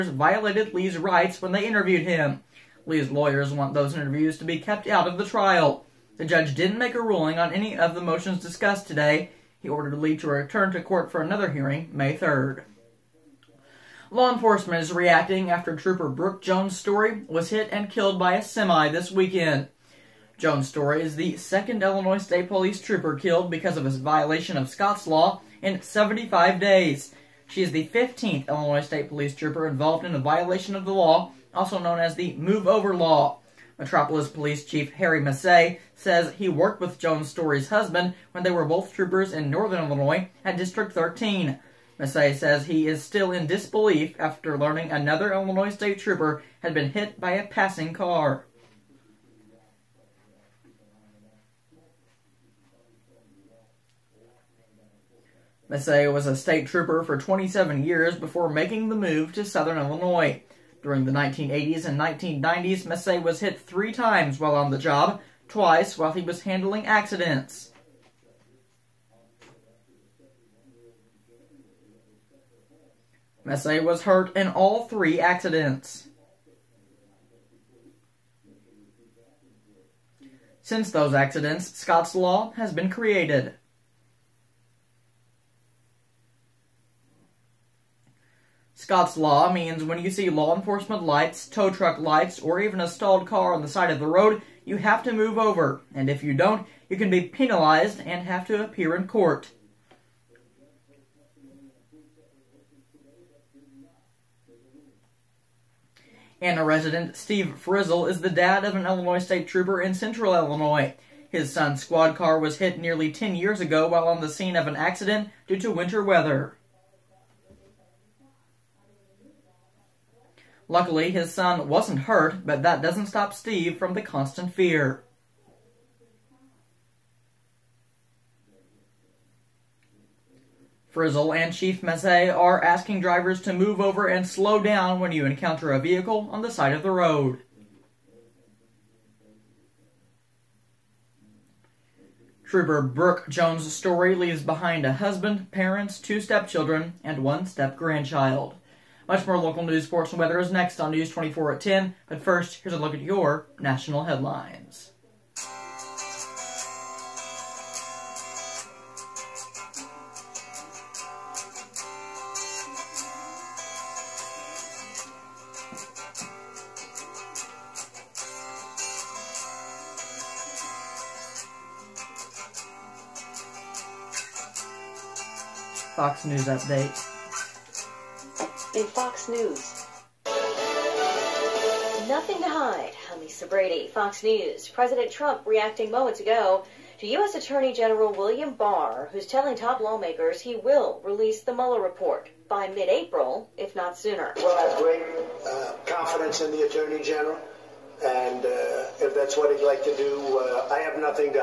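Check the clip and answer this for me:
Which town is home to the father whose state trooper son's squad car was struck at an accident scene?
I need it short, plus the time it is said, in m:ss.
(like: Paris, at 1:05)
Anna, at 1:46.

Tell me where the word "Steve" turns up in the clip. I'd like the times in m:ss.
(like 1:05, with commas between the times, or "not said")
1:47, 2:03.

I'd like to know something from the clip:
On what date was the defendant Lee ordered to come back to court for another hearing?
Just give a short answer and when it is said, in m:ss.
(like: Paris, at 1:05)
May 3, at 0:11.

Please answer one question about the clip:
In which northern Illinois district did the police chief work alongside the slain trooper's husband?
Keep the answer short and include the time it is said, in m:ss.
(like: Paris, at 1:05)
District 13, at 0:40.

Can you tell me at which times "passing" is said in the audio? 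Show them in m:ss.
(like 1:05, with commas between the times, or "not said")
0:47.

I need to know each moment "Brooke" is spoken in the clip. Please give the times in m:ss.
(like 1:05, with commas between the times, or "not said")
0:16, 2:22.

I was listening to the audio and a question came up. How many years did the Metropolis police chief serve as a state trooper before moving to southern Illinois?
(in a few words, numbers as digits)
27.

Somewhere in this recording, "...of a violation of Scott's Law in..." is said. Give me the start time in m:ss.
0:23.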